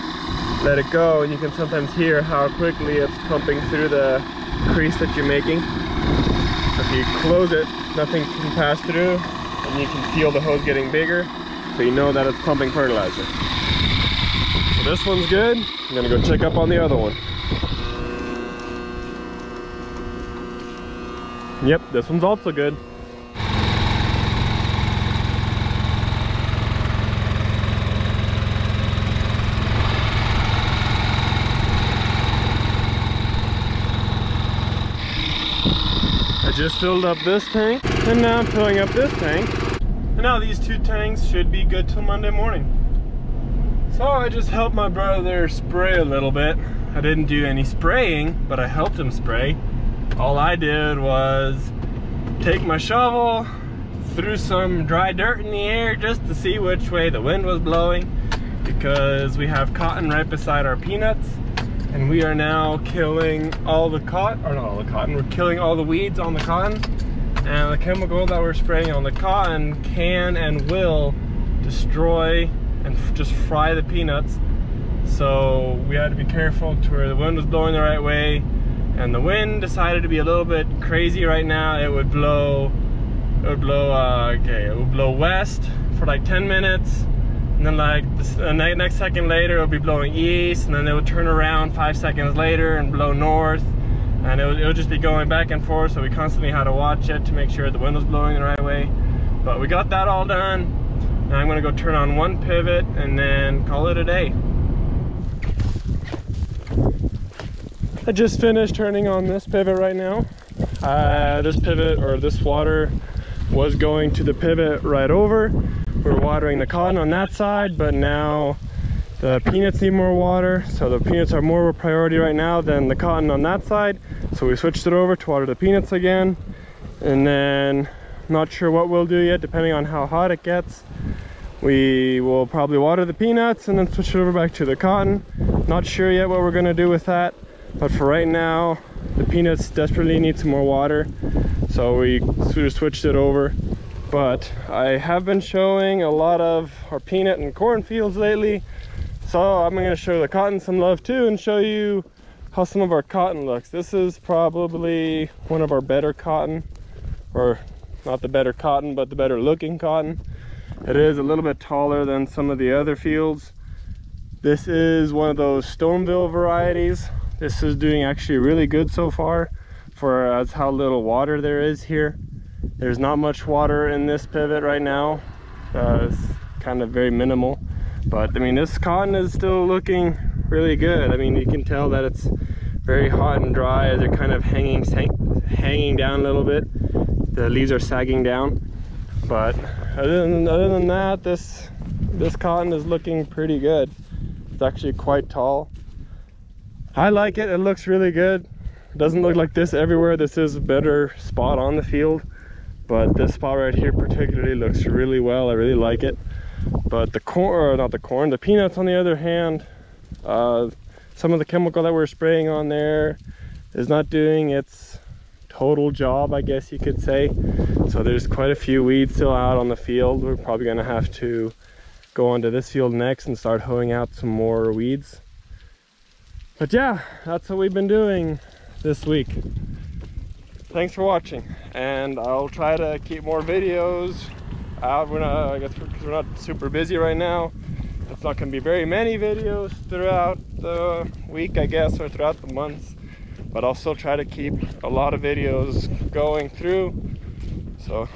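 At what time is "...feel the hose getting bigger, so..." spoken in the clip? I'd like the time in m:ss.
0:10.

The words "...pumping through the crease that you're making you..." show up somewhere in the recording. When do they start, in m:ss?
0:03.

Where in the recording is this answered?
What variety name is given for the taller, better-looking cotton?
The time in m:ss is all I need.
2:45.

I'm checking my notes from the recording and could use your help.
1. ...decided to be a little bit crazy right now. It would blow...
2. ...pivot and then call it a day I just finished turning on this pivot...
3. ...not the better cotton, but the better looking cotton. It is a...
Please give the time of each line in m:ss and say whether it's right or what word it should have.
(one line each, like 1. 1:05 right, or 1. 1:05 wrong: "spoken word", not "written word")
1. 1:19 right
2. 1:42 right
3. 2:38 right.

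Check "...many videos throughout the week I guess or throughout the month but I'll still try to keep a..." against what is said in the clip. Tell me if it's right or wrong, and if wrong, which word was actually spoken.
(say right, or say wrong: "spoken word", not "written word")
right.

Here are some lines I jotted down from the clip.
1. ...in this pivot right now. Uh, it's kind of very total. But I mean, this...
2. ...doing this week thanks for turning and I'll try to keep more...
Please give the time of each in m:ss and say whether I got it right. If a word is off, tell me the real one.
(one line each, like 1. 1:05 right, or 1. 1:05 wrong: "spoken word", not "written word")
1. 2:53 wrong: "minimal", not "total"
2. 3:47 wrong: "watching", not "turning".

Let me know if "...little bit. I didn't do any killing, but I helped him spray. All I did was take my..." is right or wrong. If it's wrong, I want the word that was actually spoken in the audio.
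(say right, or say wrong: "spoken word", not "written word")
wrong: "spraying", not "killing".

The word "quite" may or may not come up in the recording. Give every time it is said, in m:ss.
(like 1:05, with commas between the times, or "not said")
3:14, 3:38.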